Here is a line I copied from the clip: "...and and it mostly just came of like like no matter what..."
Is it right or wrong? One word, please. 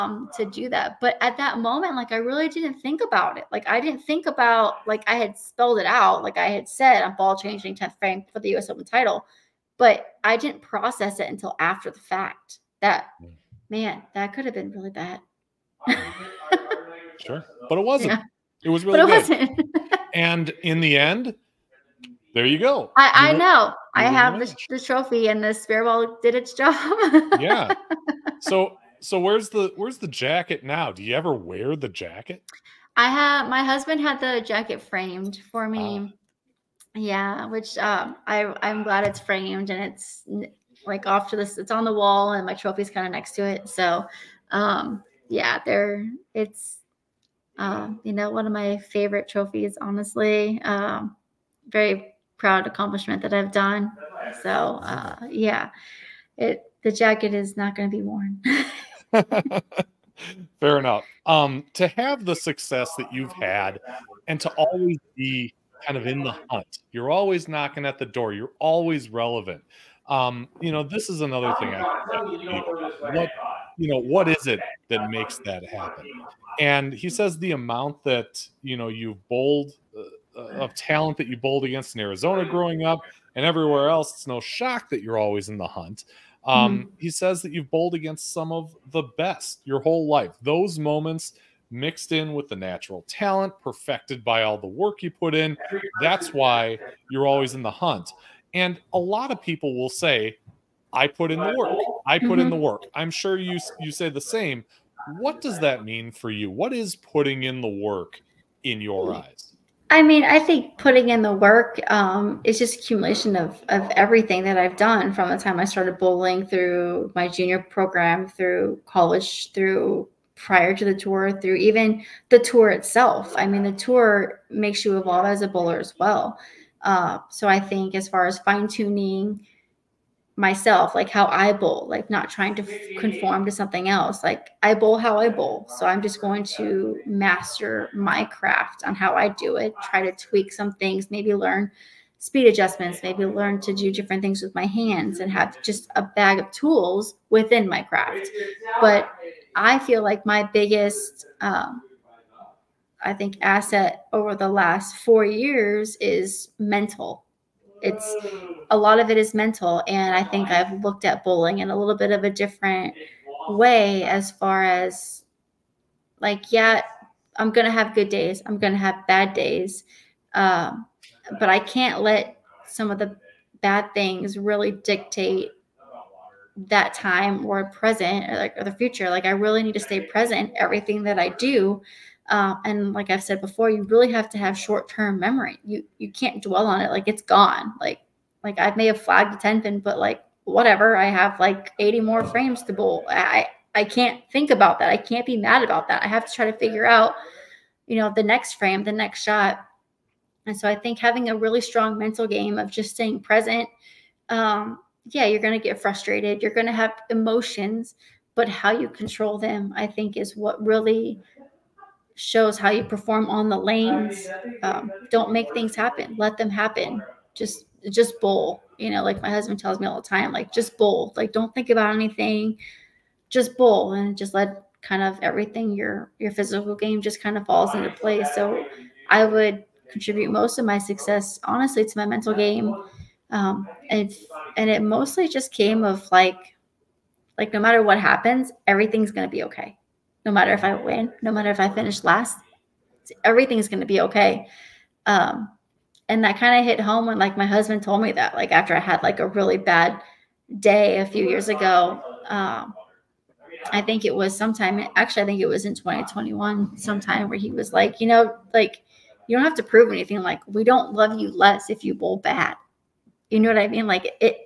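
right.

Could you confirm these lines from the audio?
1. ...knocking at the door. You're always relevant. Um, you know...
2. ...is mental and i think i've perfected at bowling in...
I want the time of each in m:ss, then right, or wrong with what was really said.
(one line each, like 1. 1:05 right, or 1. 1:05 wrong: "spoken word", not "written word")
1. 1:07 right
2. 2:39 wrong: "looked", not "perfected".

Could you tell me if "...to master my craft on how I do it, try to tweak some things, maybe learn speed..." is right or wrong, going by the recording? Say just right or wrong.
right.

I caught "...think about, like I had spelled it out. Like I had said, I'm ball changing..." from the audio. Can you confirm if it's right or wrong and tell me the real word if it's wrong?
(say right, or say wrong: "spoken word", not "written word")
right.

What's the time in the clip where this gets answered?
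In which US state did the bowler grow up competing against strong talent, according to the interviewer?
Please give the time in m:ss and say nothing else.
1:22.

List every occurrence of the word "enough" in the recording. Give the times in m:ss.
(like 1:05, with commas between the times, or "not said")
1:00.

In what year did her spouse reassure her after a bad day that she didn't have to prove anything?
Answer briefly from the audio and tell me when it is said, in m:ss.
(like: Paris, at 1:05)
2021, at 4:15.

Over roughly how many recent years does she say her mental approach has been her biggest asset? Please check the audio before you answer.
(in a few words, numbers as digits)
4.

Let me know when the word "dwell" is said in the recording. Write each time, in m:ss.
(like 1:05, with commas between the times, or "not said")
3:06.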